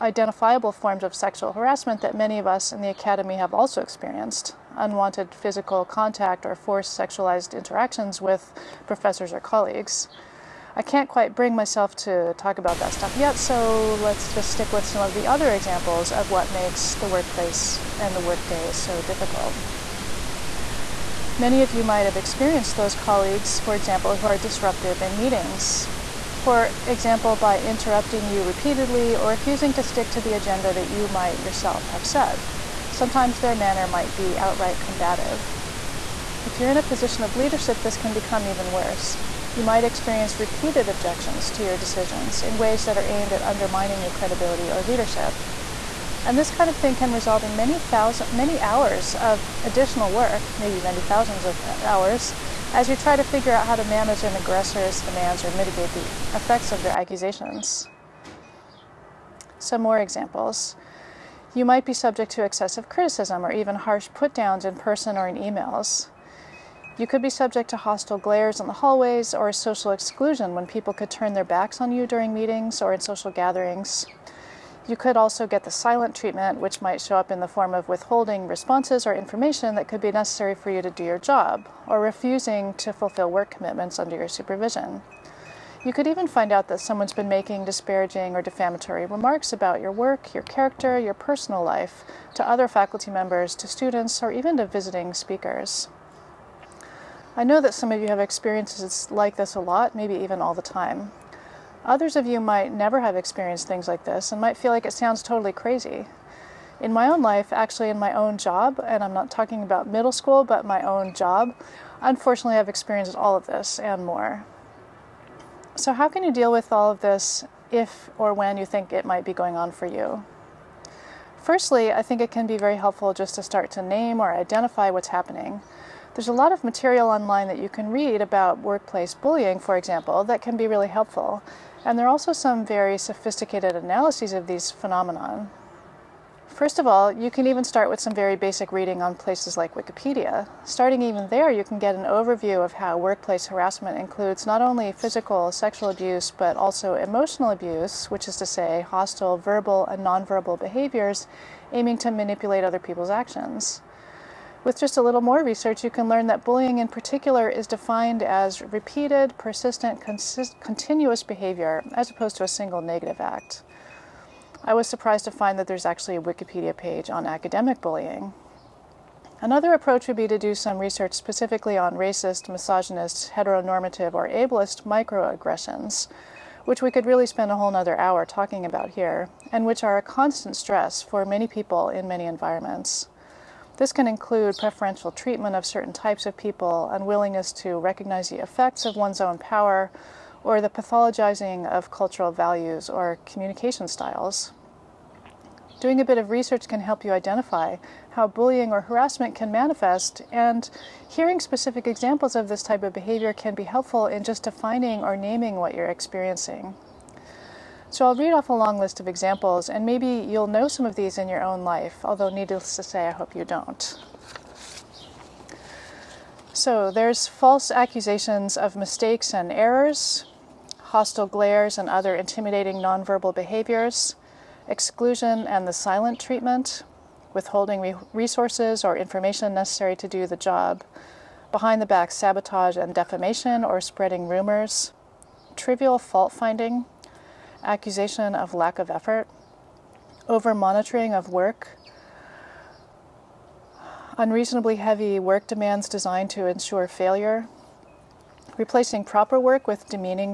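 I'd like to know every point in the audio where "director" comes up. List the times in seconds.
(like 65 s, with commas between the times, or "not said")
not said.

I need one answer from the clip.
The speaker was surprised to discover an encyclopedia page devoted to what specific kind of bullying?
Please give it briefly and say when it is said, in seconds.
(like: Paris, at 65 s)
academic bullying, at 167 s.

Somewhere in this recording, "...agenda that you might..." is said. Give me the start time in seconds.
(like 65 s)
30 s.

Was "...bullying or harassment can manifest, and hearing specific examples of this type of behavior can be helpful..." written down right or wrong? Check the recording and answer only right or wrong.
right.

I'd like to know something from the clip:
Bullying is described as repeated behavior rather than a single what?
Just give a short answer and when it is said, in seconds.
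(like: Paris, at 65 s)
negative act, at 162 s.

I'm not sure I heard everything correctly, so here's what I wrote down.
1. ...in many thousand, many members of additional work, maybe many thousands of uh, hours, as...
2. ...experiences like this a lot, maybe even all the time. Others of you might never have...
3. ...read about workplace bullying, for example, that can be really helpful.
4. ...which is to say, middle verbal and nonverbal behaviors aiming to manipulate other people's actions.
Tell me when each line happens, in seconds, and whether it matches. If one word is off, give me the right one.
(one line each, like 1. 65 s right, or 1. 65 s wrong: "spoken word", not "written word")
1. 47 s wrong: "hours", not "members"
2. 98 s right
3. 127 s right
4. 148 s wrong: "hostile", not "middle".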